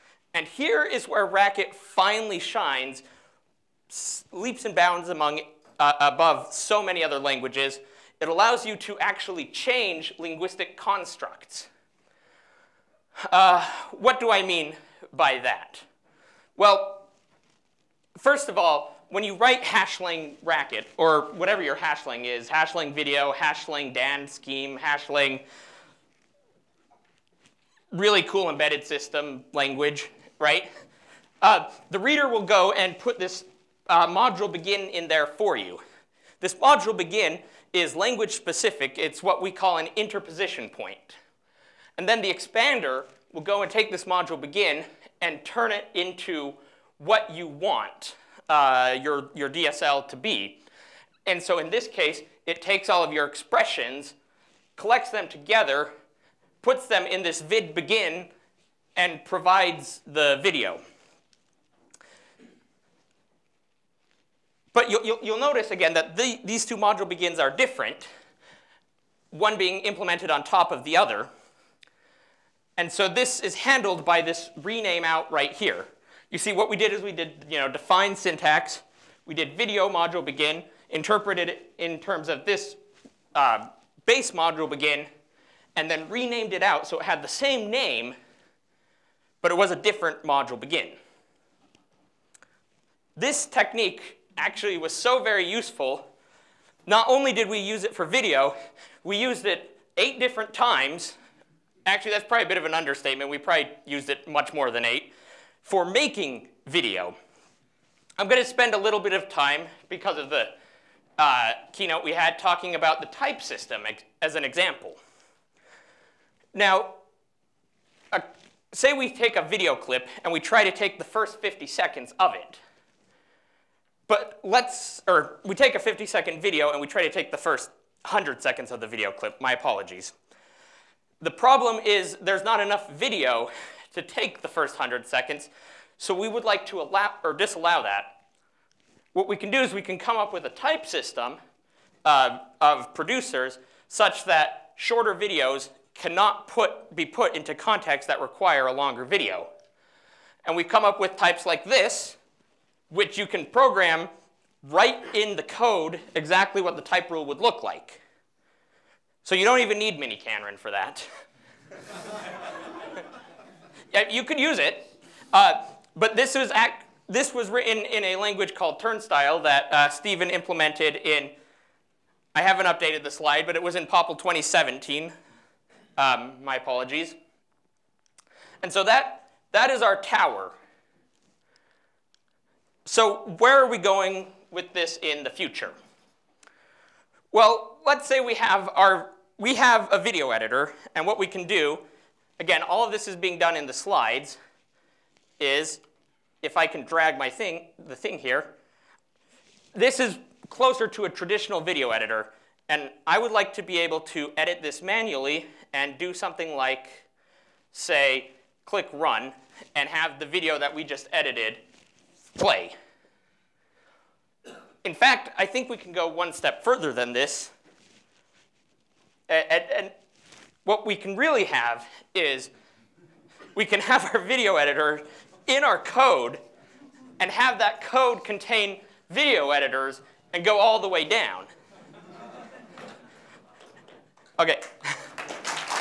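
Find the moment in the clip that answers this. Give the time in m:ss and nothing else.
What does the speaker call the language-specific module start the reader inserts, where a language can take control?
0:39.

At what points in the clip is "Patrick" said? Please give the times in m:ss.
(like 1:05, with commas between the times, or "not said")
not said.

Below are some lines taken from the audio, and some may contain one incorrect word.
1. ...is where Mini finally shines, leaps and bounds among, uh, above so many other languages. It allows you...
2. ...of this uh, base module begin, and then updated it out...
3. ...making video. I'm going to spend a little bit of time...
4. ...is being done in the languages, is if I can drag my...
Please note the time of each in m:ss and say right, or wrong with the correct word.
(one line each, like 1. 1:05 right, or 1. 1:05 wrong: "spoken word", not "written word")
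1. 0:00 wrong: "Racket", not "Mini"
2. 1:22 wrong: "renamed", not "updated"
3. 1:45 right
4. 3:13 wrong: "slides", not "languages".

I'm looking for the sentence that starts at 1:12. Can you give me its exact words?
And so this is handled by this rename out right here.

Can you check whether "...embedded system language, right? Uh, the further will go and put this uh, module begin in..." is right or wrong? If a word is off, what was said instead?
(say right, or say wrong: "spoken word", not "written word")
wrong: "reader", not "further".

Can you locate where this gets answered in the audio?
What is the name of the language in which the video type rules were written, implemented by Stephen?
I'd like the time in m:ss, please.
2:48.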